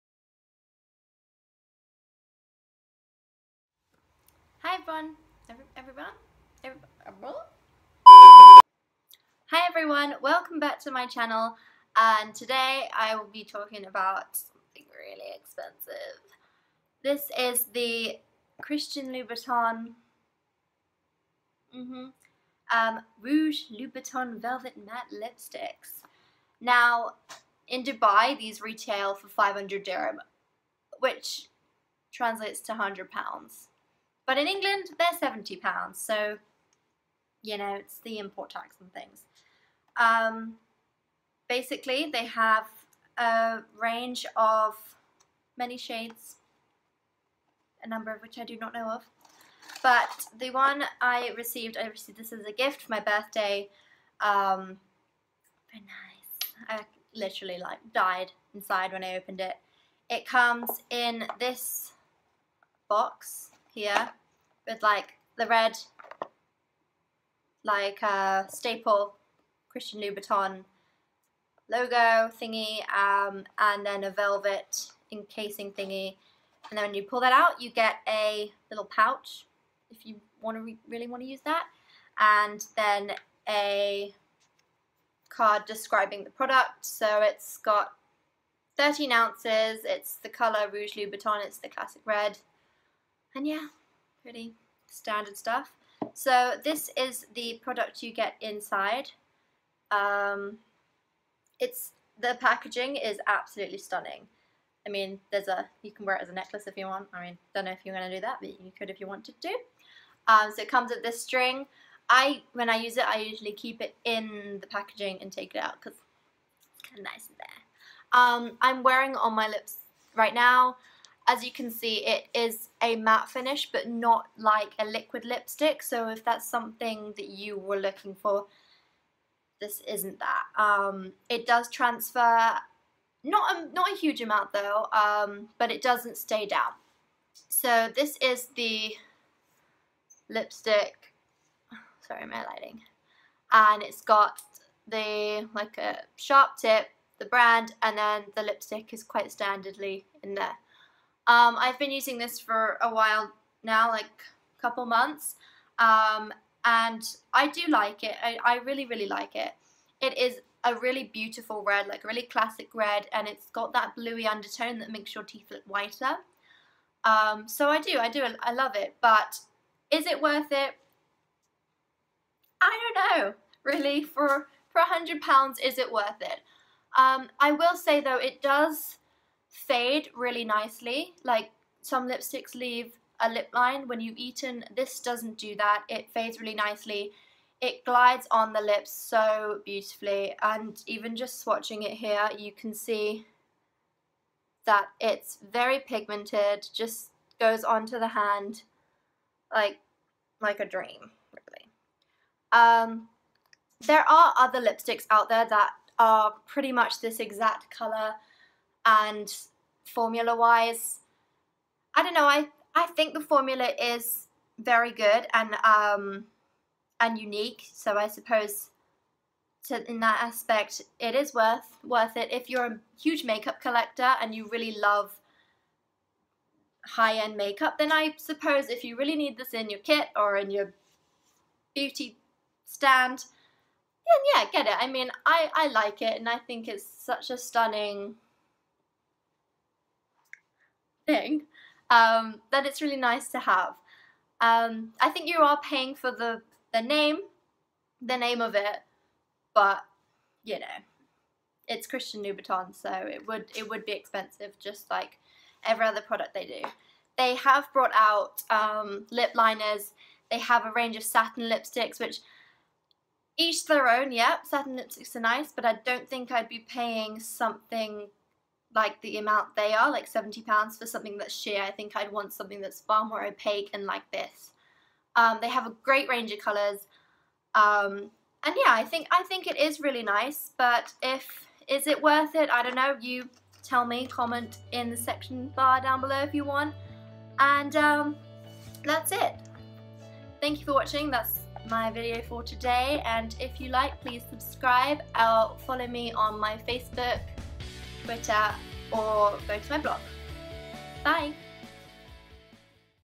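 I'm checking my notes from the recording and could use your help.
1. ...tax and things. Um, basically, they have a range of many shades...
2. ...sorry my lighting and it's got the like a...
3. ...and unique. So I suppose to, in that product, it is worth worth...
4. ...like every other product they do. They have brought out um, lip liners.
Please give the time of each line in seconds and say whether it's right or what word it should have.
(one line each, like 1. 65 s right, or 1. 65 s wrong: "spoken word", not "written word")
1. 38 s right
2. 142 s right
3. 216 s wrong: "aspect", not "product"
4. 254 s right.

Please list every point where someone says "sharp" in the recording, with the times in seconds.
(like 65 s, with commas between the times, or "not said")
146 s.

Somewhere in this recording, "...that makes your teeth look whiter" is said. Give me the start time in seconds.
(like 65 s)
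164 s.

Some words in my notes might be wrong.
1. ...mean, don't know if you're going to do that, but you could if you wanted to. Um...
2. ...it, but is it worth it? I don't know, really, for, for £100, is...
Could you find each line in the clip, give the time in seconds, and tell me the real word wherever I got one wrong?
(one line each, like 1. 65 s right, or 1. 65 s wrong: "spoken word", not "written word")
1. 107 s right
2. 168 s right.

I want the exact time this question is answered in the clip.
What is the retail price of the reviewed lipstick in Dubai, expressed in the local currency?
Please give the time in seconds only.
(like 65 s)
29 s.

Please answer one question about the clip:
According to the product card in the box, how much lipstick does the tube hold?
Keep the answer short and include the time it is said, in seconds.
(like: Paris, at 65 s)
13 ounces, at 88 s.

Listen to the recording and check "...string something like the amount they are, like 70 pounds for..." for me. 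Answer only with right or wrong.
wrong.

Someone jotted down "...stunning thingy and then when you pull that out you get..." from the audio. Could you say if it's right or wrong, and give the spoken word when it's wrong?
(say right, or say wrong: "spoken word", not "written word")
wrong: "encasing", not "stunning".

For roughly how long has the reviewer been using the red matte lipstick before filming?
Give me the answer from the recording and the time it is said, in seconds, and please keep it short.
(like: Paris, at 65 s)
a couple months, at 154 s.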